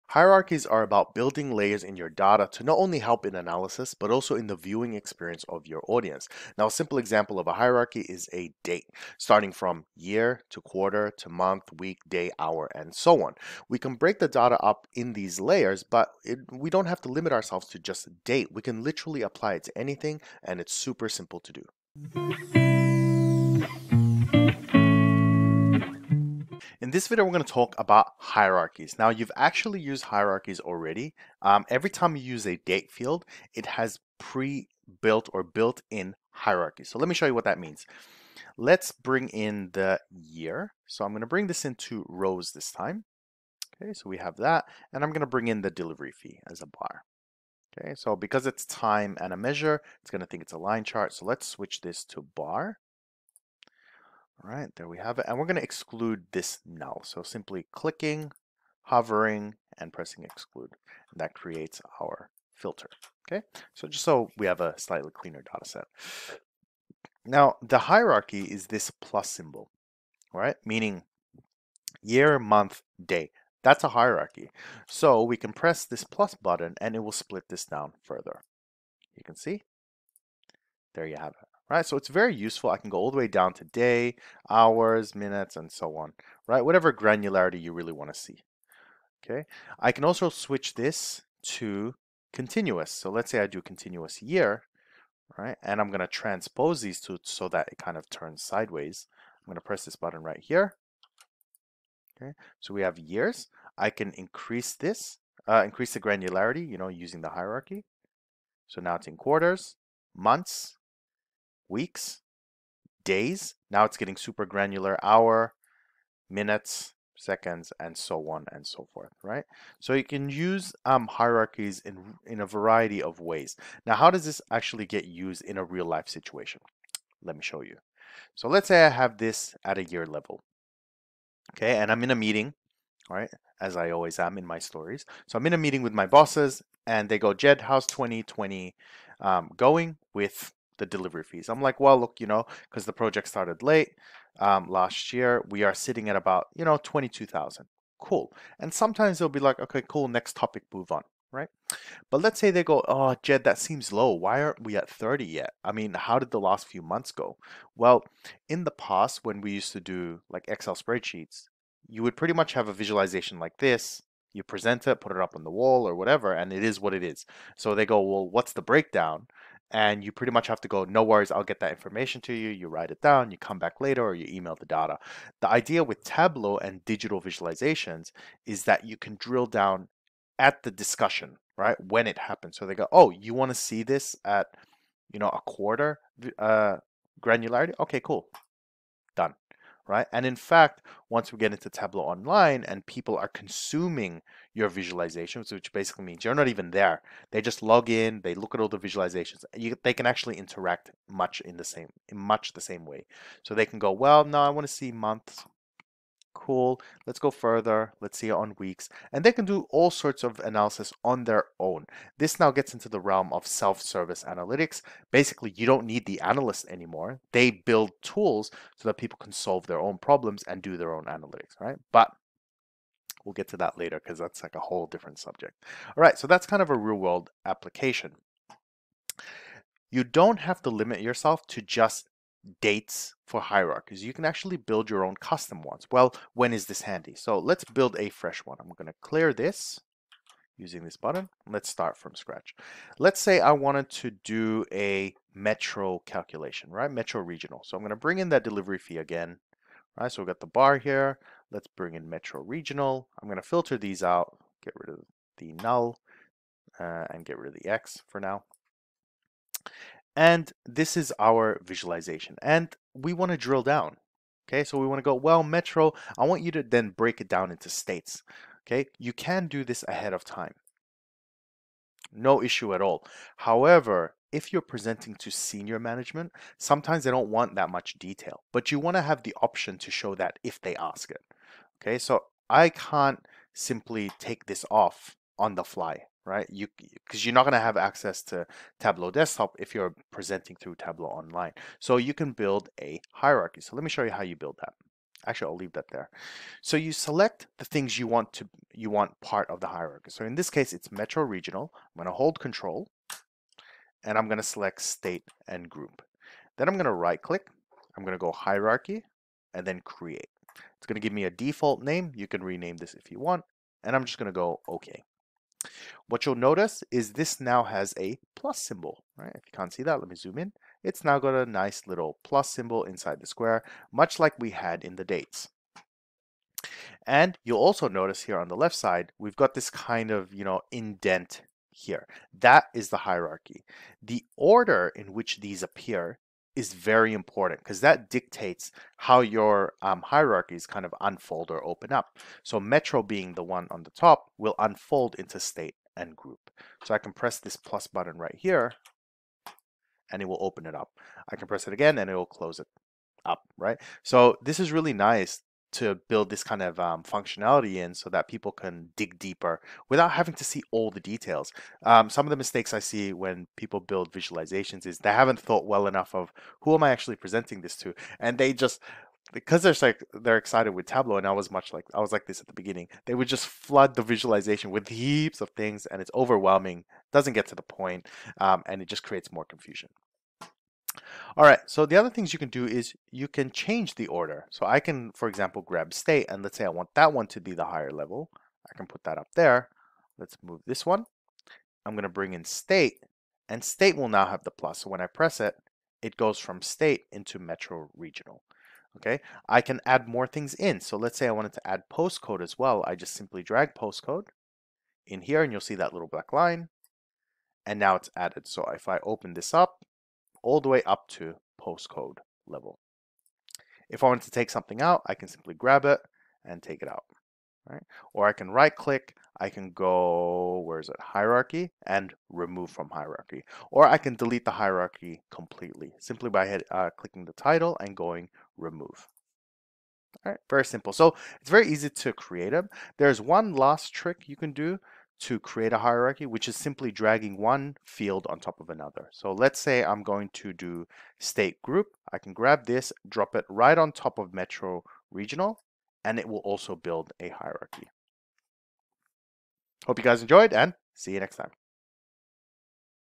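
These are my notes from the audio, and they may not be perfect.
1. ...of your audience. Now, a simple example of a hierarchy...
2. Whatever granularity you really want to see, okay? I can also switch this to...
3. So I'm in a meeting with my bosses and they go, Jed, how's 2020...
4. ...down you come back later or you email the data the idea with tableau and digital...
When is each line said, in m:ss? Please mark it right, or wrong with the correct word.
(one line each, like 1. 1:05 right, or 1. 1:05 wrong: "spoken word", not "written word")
1. 0:05 right
2. 1:26 right
3. 2:15 right
4. 2:53 right.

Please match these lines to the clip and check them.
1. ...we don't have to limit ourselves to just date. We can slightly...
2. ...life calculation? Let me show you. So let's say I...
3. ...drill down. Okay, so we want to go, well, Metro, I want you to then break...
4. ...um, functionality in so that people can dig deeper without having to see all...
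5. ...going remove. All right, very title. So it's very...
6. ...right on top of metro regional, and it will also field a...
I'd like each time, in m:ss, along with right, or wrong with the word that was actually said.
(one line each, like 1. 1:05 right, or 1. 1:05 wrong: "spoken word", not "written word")
1. 0:16 wrong: "literally", not "slightly"
2. 2:05 wrong: "situation", not "calculation"
3. 4:23 right
4. 5:56 right
5. 7:07 wrong: "simple", not "title"
6. 7:23 wrong: "build", not "field".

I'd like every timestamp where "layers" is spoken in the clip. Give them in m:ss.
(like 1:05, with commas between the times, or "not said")
0:01, 0:15.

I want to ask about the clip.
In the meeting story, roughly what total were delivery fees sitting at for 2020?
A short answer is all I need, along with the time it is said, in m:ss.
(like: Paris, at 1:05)
22,000, at 2:26.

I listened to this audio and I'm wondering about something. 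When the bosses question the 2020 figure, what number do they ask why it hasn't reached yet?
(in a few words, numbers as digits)
30.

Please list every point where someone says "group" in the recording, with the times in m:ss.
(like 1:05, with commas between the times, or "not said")
5:05, 5:46, 7:21.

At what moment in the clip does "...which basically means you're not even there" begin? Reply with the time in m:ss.
3:15.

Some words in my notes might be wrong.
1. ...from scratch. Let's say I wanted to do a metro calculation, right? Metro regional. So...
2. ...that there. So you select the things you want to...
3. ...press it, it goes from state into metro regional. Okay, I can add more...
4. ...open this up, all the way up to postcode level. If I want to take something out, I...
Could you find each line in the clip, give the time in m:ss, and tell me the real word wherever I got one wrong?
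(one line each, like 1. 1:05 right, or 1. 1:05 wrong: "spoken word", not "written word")
1. 4:01 right
2. 4:55 right
3. 6:35 right
4. 6:49 right.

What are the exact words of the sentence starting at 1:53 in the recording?
Now it's getting super granular, hour, minutes, seconds, and so on and so forth, right?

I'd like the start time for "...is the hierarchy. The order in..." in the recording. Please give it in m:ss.
5:32.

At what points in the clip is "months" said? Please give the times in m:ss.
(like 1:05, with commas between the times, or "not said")
0:11, 1:12, 1:50, 2:36, 3:24.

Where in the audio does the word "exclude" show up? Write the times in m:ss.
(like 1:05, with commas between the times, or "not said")
0:55, 1:00.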